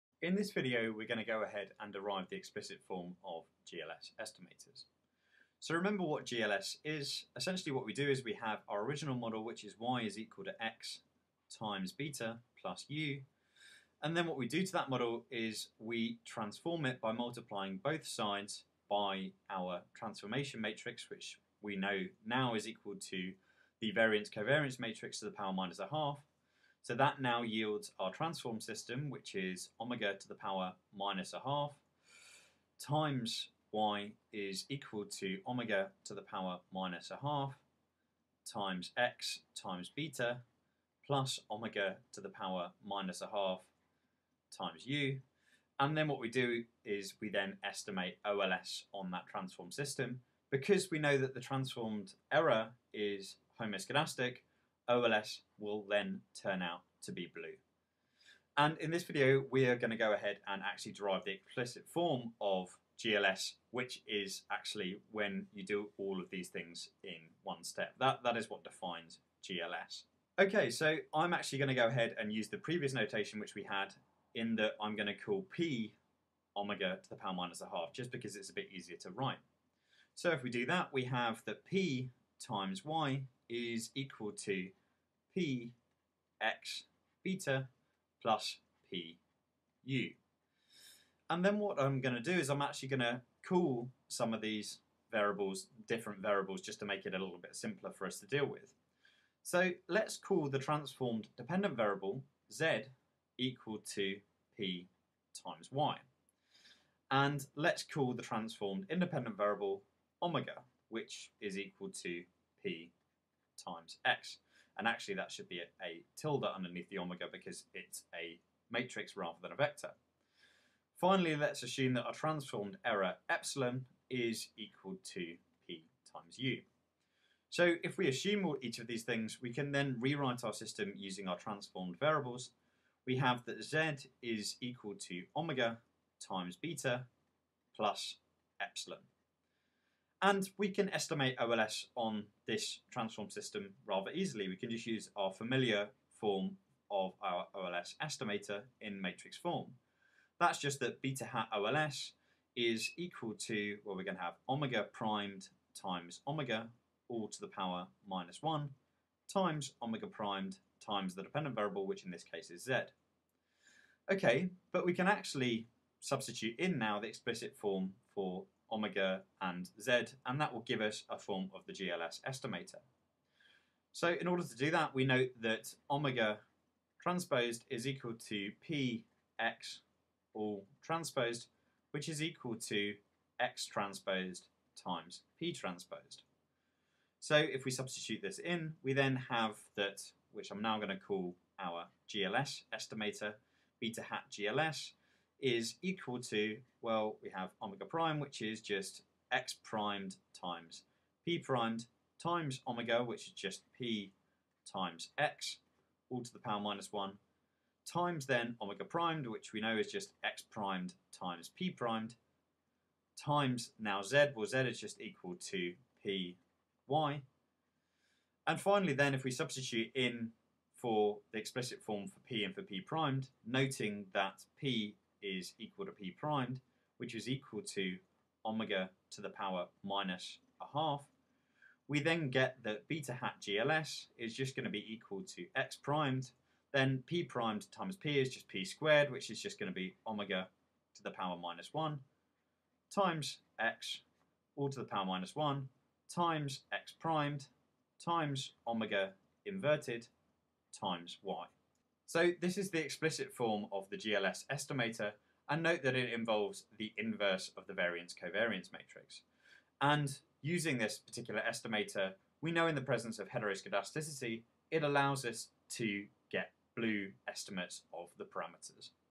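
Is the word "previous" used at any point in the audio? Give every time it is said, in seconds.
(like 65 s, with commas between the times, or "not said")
72 s.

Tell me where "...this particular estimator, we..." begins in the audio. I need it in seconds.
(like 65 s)
260 s.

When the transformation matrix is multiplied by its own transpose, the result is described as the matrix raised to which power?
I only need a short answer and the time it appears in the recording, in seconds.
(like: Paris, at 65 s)
p squared, at 238 s.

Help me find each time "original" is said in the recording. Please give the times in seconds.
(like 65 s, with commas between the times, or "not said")
8 s.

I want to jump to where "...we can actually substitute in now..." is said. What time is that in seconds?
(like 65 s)
164 s.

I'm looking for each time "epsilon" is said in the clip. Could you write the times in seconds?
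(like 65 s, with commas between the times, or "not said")
123 s, 138 s.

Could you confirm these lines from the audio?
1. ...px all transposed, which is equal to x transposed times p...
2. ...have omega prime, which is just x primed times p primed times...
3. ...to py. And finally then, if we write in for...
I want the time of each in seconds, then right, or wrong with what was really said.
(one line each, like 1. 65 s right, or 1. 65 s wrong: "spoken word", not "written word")
1. 178 s right
2. 197 s right
3. 215 s wrong: "substitute", not "write".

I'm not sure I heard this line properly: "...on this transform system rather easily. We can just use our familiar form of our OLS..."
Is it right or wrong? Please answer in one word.
right.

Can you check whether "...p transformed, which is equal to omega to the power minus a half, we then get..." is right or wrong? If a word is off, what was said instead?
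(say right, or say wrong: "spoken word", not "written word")
wrong: "primed", not "transformed".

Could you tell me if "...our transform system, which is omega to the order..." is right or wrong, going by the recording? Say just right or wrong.
wrong.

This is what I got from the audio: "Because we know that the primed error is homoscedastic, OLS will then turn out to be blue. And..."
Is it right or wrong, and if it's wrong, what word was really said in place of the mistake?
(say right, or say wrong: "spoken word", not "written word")
wrong: "transformed", not "primed".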